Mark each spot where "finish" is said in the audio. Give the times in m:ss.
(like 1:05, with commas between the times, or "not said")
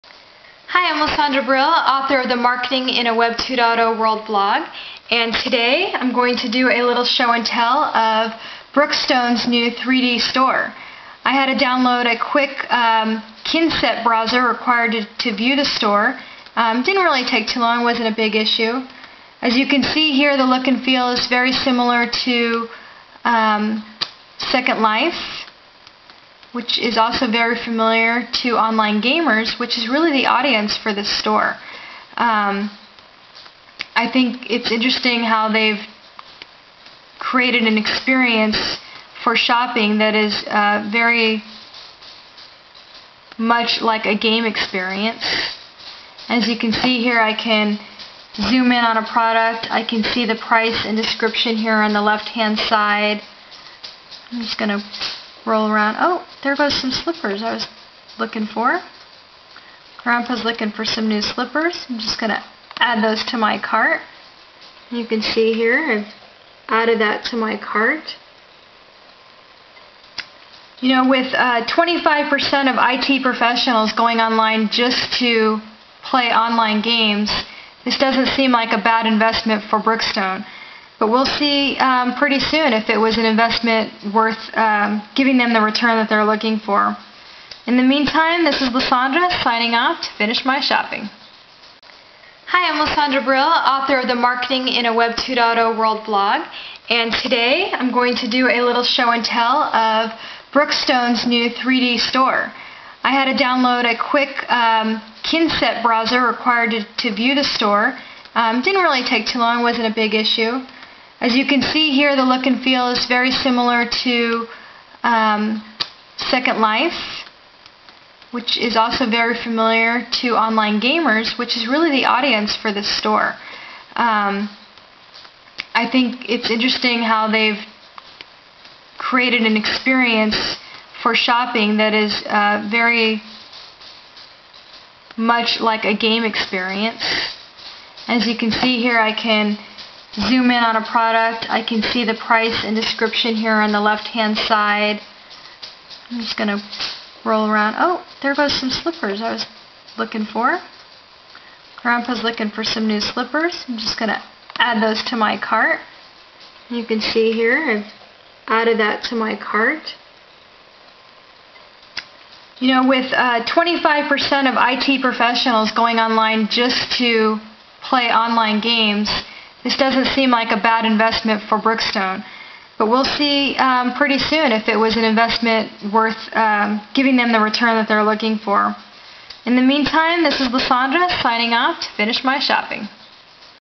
1:30, 3:01.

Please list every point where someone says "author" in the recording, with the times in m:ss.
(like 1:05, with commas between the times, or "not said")
0:01, 1:33.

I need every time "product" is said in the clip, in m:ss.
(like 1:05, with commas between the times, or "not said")
0:49, 2:20.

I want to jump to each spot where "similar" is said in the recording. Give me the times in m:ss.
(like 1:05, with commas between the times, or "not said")
0:21, 1:53.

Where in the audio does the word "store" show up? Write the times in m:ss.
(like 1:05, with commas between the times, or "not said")
0:10, 0:15, 0:31, 1:41, 1:47, 2:02.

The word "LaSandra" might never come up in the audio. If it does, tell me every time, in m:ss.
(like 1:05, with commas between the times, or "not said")
0:01, 1:28, 1:32, 3:00.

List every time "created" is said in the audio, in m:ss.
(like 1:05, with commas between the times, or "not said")
0:37, 2:08.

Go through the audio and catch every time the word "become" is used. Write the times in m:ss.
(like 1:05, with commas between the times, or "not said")
not said.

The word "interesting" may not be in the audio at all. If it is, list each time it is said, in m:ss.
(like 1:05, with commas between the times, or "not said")
0:34, 2:06.